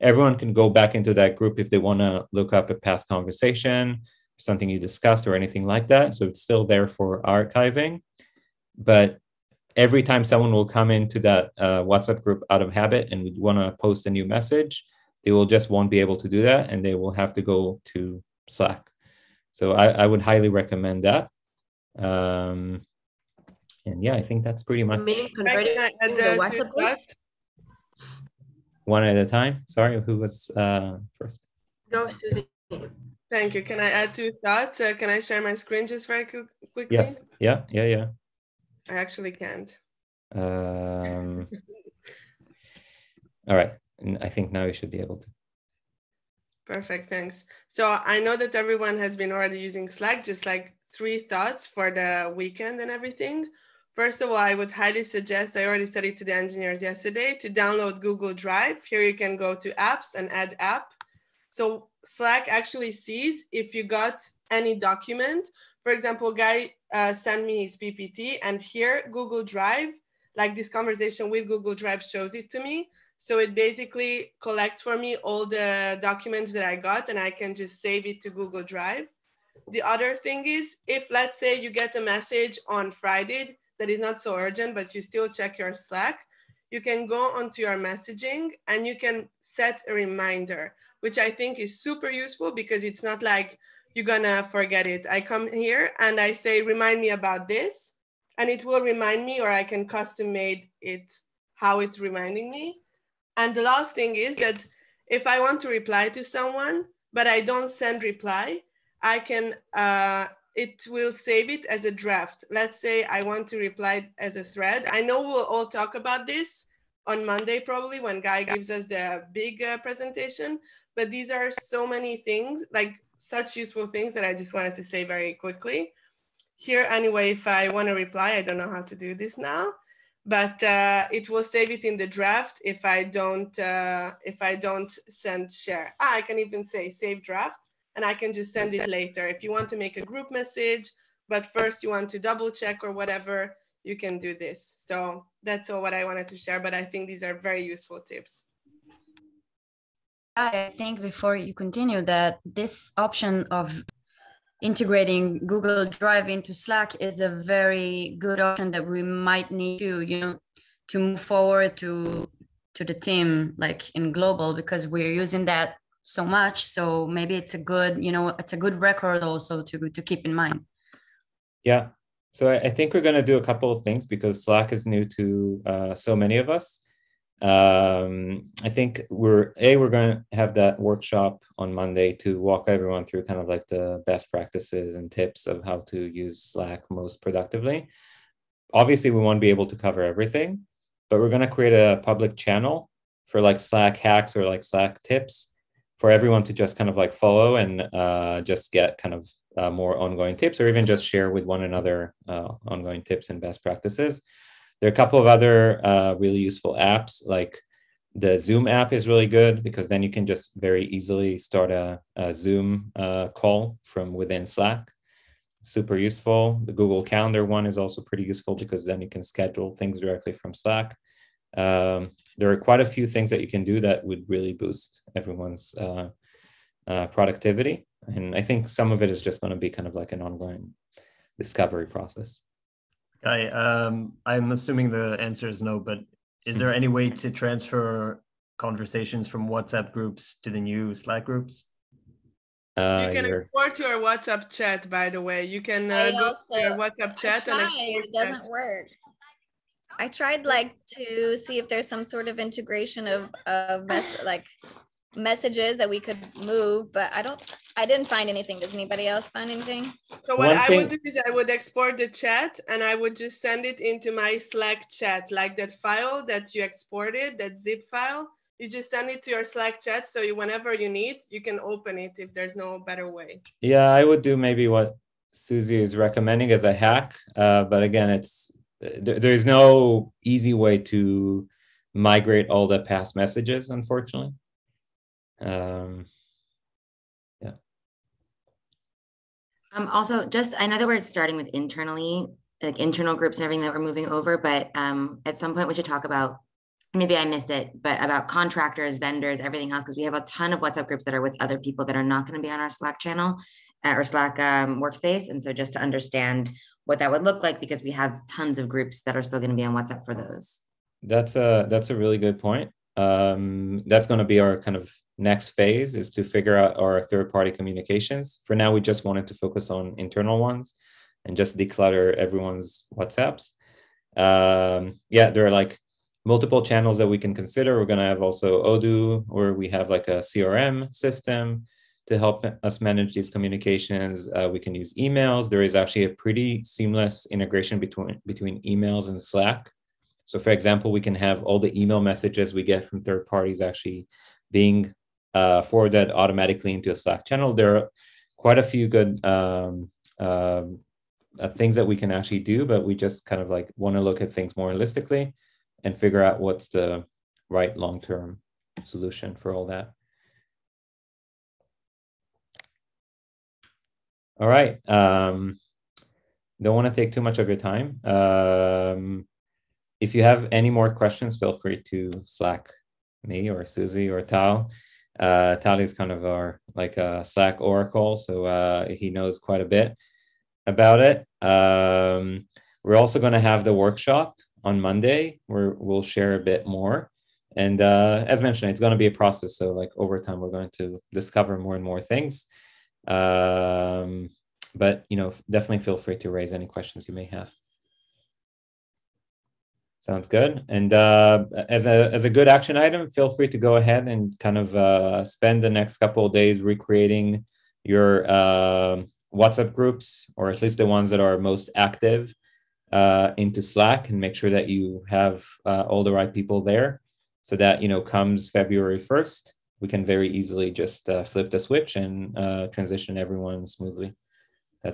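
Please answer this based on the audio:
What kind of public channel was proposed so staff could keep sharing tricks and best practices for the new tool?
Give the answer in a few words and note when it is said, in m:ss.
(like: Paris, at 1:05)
Slack hacks, at 3:13.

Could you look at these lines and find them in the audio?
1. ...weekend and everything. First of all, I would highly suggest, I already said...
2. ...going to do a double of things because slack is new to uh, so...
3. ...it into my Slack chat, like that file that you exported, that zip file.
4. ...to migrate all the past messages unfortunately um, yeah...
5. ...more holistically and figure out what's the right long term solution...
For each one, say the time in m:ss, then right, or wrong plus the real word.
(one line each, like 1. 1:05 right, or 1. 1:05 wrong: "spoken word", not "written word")
1. 0:52 right
2. 2:53 wrong: "couple", not "double"
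3. 4:23 right
4. 4:40 right
5. 5:54 right.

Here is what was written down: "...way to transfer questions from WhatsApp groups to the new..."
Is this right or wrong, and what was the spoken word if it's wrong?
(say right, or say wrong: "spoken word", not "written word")
wrong: "conversations", not "questions".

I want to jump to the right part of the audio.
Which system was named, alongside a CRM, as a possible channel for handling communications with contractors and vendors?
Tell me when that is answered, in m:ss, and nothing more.
5:28.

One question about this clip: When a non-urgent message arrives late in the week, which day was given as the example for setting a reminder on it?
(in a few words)
Friday.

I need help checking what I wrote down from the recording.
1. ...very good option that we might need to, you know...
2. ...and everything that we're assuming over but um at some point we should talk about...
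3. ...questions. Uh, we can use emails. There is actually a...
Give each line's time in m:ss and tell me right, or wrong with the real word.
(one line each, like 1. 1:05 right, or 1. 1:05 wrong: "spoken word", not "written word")
1. 2:37 right
2. 4:53 wrong: "moving", not "assuming"
3. 5:33 wrong: "communications", not "questions".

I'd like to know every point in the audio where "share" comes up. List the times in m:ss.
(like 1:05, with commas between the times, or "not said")
0:35, 2:15, 2:26, 3:21, 6:26.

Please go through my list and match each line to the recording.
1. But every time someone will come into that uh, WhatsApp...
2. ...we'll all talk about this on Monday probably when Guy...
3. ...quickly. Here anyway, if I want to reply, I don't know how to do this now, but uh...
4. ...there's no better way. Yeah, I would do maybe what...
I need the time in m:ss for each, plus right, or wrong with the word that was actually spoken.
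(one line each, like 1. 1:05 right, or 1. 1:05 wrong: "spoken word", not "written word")
1. 0:08 right
2. 1:55 right
3. 2:05 right
4. 4:32 right.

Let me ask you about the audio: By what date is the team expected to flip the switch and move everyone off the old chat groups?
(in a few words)
February 1.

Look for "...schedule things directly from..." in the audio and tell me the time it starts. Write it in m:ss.
3:39.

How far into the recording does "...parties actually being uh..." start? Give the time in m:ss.
5:43.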